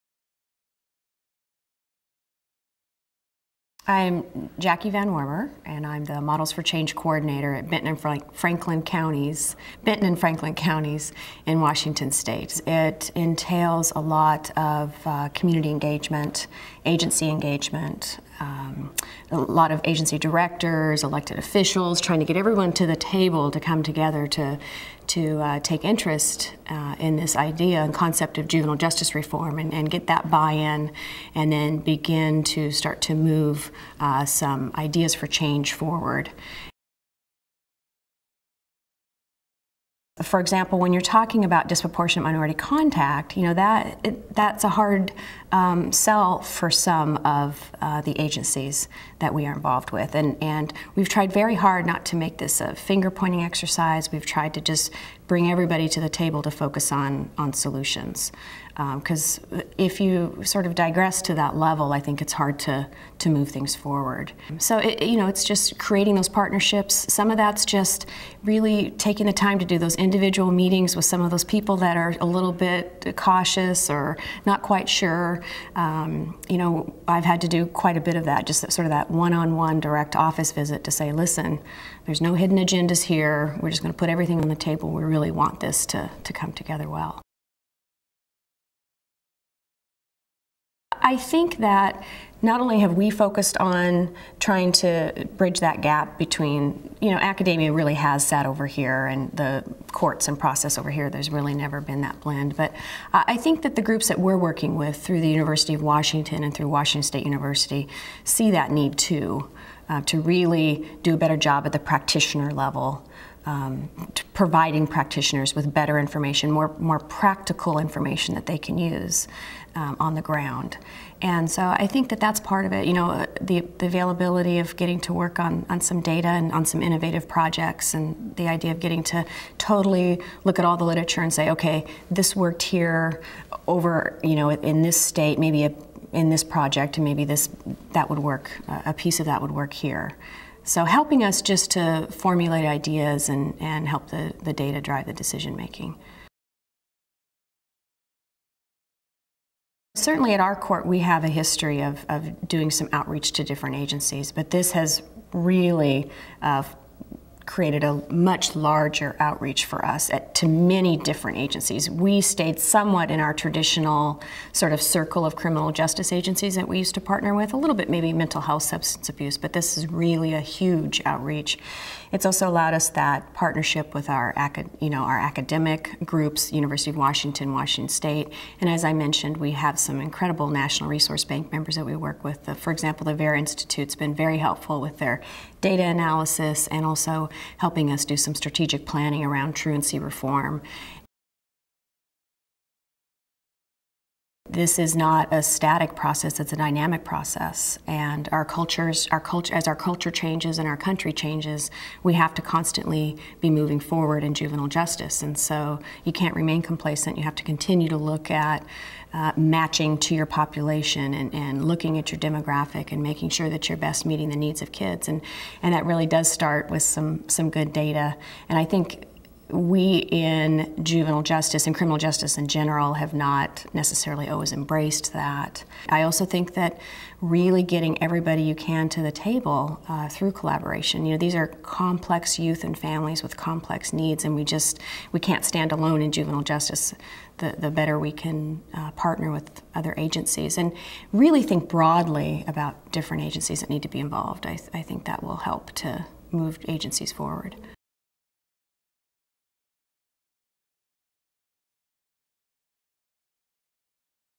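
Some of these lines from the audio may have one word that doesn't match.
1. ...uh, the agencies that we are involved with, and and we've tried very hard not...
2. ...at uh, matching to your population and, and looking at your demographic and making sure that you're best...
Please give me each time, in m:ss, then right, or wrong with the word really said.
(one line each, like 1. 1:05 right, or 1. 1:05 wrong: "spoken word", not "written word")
1. 0:47 right
2. 3:28 right.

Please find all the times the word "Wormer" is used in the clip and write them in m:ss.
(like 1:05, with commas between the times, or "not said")
0:05.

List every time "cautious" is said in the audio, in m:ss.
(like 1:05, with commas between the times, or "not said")
1:13.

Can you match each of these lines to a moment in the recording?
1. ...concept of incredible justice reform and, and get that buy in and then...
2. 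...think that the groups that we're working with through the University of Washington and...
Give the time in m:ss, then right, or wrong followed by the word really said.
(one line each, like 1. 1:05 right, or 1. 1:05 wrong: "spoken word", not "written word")
1. 0:27 wrong: "juvenile", not "incredible"
2. 1:43 right.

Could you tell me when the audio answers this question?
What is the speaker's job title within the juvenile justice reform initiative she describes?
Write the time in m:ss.
0:06.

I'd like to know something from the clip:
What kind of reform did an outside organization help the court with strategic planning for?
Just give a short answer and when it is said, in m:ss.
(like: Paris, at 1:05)
Truancy reform, at 3:09.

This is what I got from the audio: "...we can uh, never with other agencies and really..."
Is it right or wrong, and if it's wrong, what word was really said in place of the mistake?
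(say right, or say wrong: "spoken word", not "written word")
wrong: "partner", not "never".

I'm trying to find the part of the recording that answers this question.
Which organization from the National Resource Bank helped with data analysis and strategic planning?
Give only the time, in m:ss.
3:03.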